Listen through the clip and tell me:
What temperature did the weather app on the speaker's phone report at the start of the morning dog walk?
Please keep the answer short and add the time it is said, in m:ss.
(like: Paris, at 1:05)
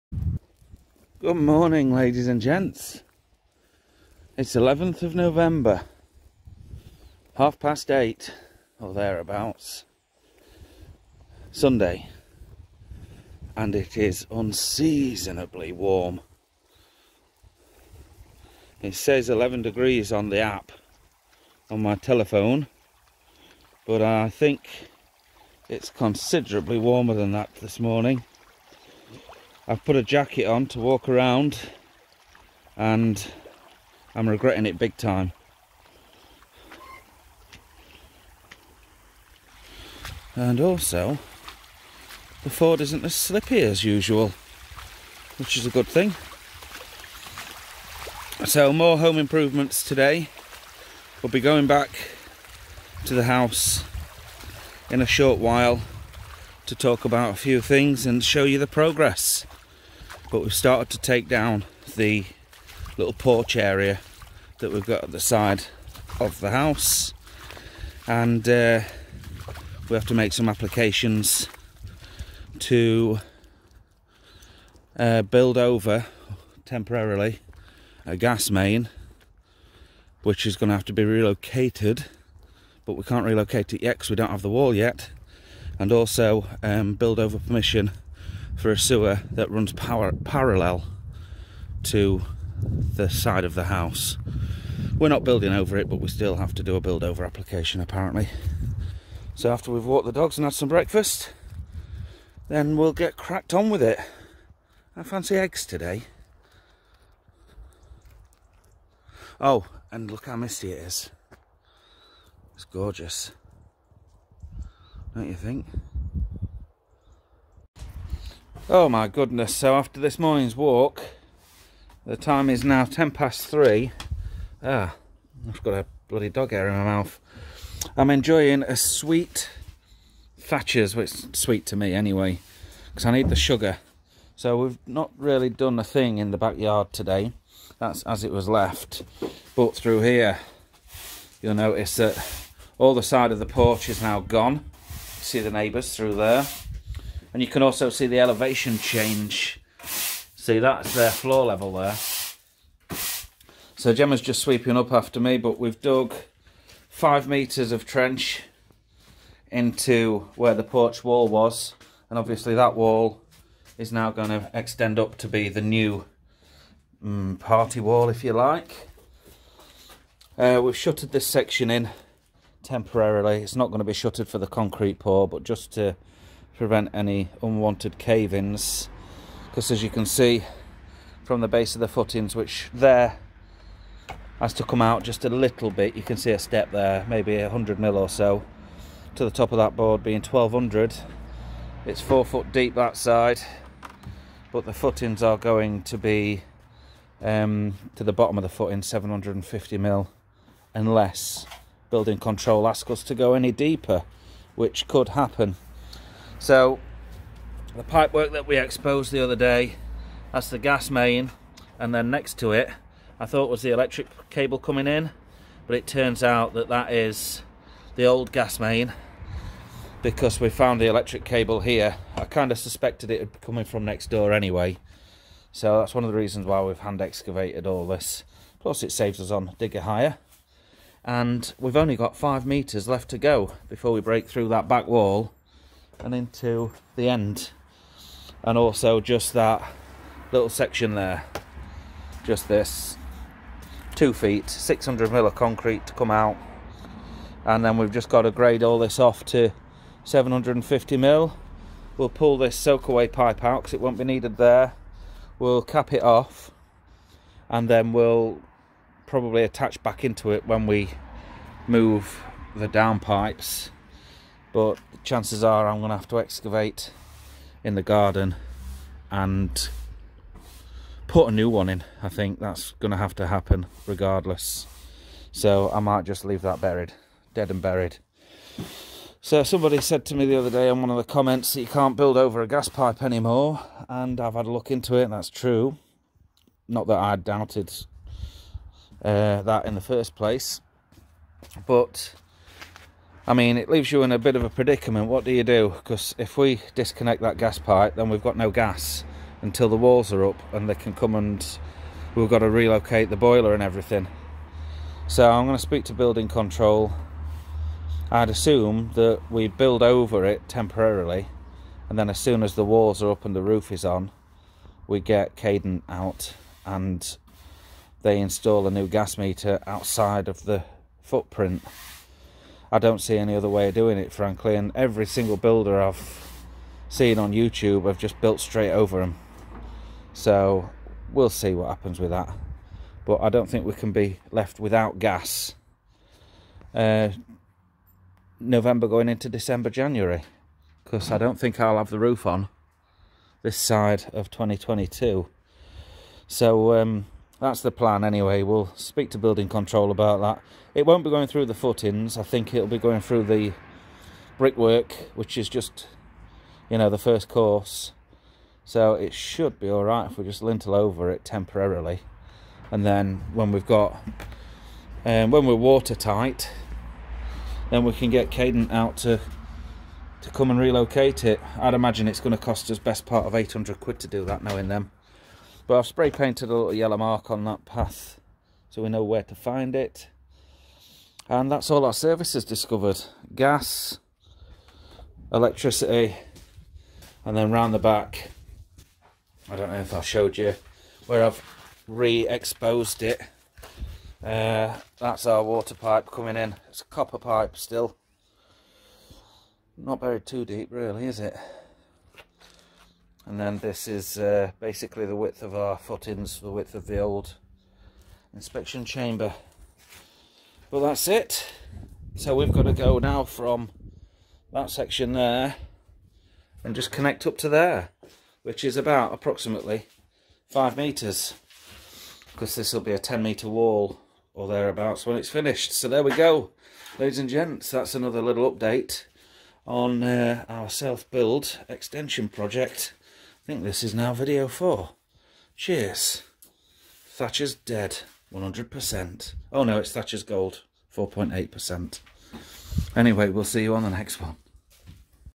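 11 degrees, at 0:19.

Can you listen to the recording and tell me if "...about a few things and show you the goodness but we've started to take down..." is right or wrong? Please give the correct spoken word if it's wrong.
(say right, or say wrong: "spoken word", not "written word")
wrong: "progress", not "goodness".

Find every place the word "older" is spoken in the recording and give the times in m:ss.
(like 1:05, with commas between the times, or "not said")
not said.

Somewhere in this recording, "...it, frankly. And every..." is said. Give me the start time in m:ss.
5:23.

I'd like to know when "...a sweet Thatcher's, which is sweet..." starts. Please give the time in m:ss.
2:08.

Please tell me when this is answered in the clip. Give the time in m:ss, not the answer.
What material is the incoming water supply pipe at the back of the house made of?
6:36.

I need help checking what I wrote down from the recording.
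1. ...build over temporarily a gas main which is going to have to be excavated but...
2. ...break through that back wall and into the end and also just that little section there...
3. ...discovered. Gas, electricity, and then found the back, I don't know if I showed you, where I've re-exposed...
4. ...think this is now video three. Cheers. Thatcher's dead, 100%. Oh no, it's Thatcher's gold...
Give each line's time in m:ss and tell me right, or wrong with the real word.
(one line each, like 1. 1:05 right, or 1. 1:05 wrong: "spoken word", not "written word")
1. 1:15 wrong: "relocated", not "excavated"
2. 3:54 right
3. 6:22 wrong: "round", not "found"
4. 7:13 wrong: "four", not "three".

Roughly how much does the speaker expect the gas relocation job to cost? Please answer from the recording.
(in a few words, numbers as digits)
800 quid.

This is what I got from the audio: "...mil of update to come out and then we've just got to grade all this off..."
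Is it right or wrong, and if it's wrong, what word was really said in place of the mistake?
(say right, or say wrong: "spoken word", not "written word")
wrong: "concrete", not "update".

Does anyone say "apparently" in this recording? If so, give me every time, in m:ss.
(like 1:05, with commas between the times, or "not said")
1:37.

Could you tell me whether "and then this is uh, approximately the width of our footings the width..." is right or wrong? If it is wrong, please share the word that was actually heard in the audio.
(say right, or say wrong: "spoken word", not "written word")
wrong: "basically", not "approximately".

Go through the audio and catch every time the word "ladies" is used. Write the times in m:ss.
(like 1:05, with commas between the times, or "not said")
0:01, 7:06.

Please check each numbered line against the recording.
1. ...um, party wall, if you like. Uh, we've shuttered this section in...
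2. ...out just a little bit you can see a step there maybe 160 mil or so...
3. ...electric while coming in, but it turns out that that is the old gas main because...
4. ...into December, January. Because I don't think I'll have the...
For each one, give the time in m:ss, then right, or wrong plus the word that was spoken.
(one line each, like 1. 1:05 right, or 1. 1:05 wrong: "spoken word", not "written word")
1. 2:47 right
2. 3:04 wrong: "100", not "160"
3. 3:33 wrong: "cable", not "while"
4. 5:39 right.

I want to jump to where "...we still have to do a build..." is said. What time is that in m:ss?
1:35.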